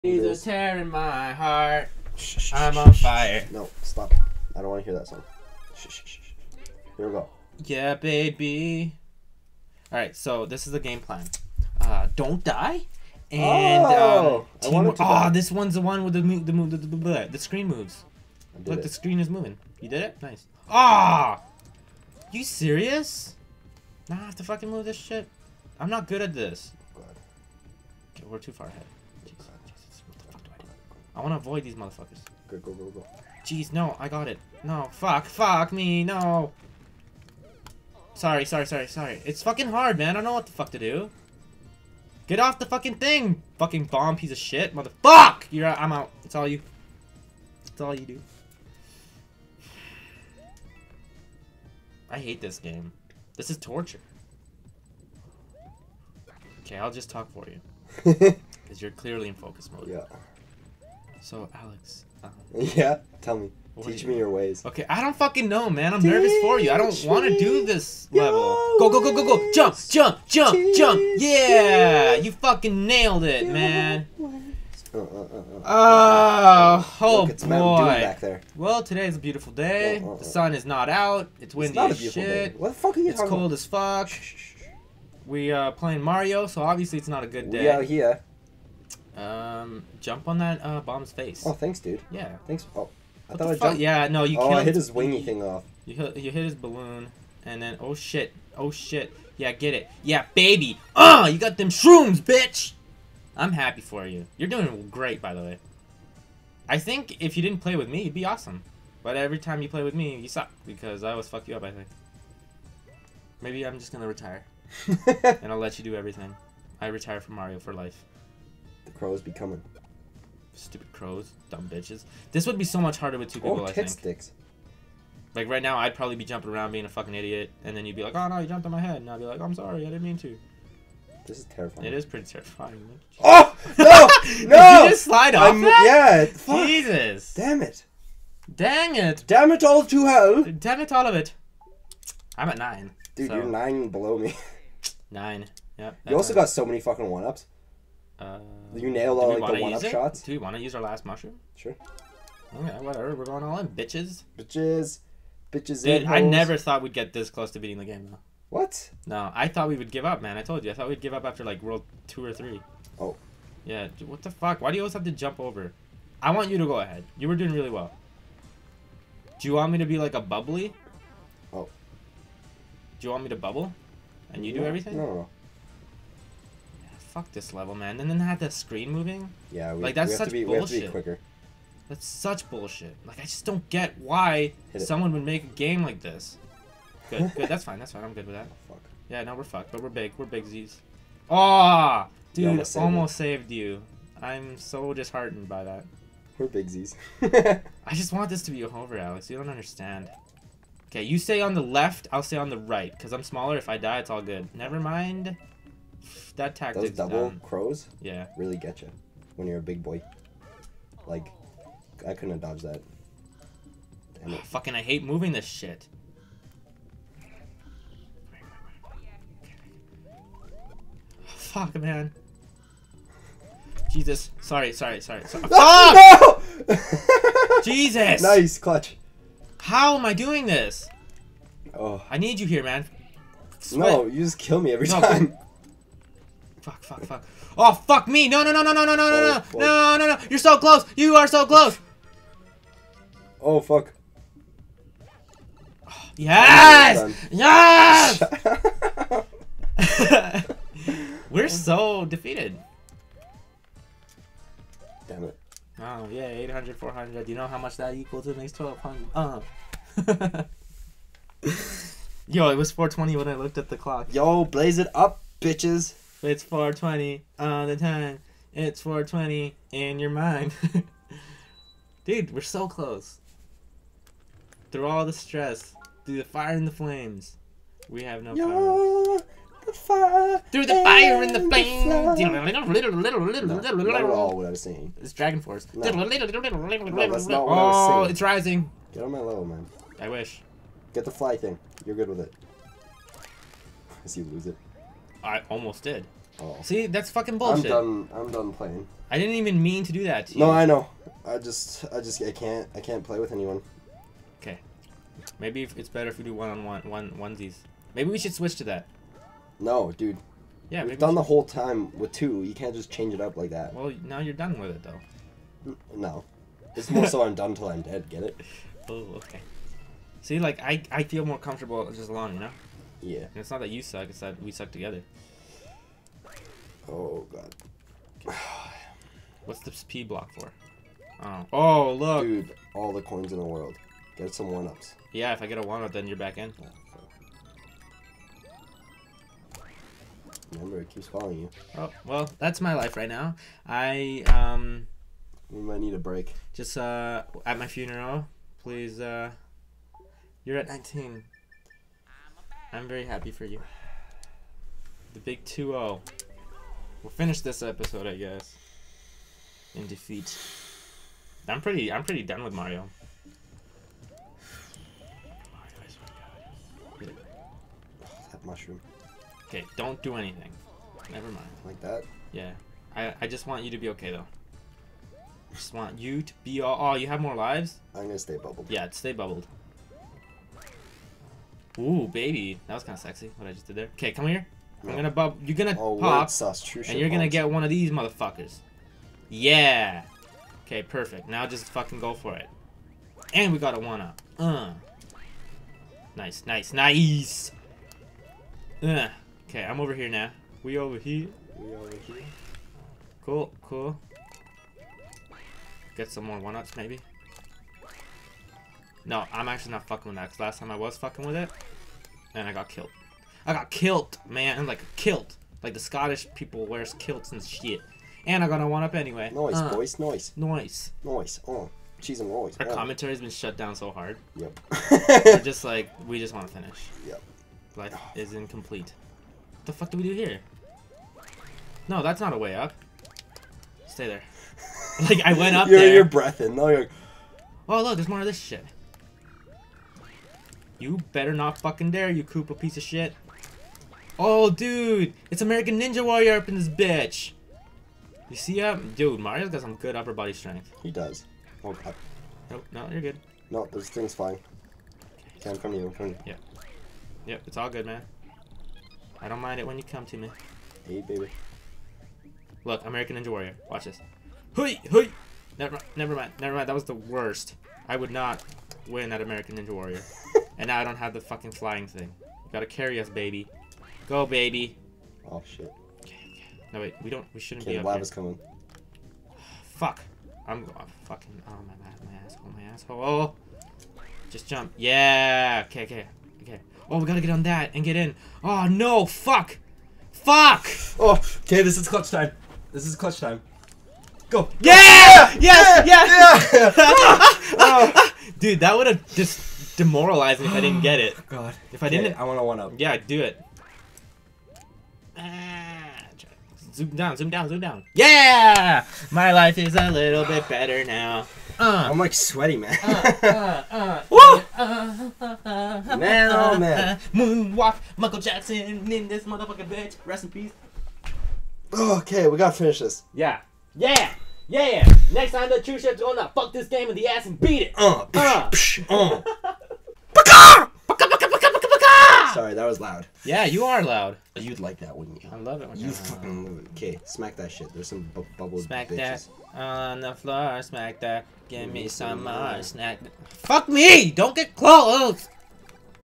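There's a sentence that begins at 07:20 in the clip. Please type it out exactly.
You better not fucking dare, you Koopa piece of shit.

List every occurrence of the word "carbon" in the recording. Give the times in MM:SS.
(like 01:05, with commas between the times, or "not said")
not said.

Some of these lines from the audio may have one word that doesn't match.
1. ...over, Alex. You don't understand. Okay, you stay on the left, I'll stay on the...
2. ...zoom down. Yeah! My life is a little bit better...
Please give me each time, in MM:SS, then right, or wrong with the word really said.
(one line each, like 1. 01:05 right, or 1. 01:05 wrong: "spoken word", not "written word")
1. 03:18 right
2. 08:27 right.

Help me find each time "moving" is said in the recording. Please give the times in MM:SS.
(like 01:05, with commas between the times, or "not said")
00:19, 02:58, 03:35.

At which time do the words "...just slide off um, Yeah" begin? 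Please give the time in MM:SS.
02:14.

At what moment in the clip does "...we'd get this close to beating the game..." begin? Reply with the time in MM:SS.
02:36.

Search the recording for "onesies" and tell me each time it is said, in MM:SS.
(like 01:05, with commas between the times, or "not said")
05:07.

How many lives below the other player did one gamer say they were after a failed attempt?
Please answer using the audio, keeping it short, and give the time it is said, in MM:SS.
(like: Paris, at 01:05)
9, at 02:23.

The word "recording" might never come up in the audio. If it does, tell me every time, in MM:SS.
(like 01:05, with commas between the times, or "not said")
not said.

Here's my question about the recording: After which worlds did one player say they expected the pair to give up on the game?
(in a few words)
world two or three.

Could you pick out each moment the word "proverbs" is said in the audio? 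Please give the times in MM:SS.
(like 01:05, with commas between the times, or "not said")
not said.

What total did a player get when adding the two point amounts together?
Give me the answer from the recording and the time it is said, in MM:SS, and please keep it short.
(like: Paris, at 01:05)
1200, at 04:18.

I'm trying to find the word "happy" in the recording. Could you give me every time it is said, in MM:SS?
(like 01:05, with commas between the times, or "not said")
01:43, 05:53.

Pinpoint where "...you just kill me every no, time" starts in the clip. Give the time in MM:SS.
03:54.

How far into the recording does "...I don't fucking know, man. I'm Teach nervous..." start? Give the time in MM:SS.
01:04.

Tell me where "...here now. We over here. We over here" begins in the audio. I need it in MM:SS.
06:39.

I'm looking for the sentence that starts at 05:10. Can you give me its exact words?
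Yeah, we've done we the whole time with two.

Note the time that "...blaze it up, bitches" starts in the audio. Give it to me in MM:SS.
04:24.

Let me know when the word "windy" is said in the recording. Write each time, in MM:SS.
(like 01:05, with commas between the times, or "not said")
01:21.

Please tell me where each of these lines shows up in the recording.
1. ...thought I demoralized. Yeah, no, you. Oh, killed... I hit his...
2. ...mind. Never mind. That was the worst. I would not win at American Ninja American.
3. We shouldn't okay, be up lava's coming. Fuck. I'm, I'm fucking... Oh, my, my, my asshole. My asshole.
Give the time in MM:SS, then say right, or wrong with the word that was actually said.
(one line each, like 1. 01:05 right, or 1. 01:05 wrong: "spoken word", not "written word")
1. 01:33 wrong: "jumped", not "demoralized"
2. 07:46 wrong: "Warrior", not "American"
3. 07:57 right.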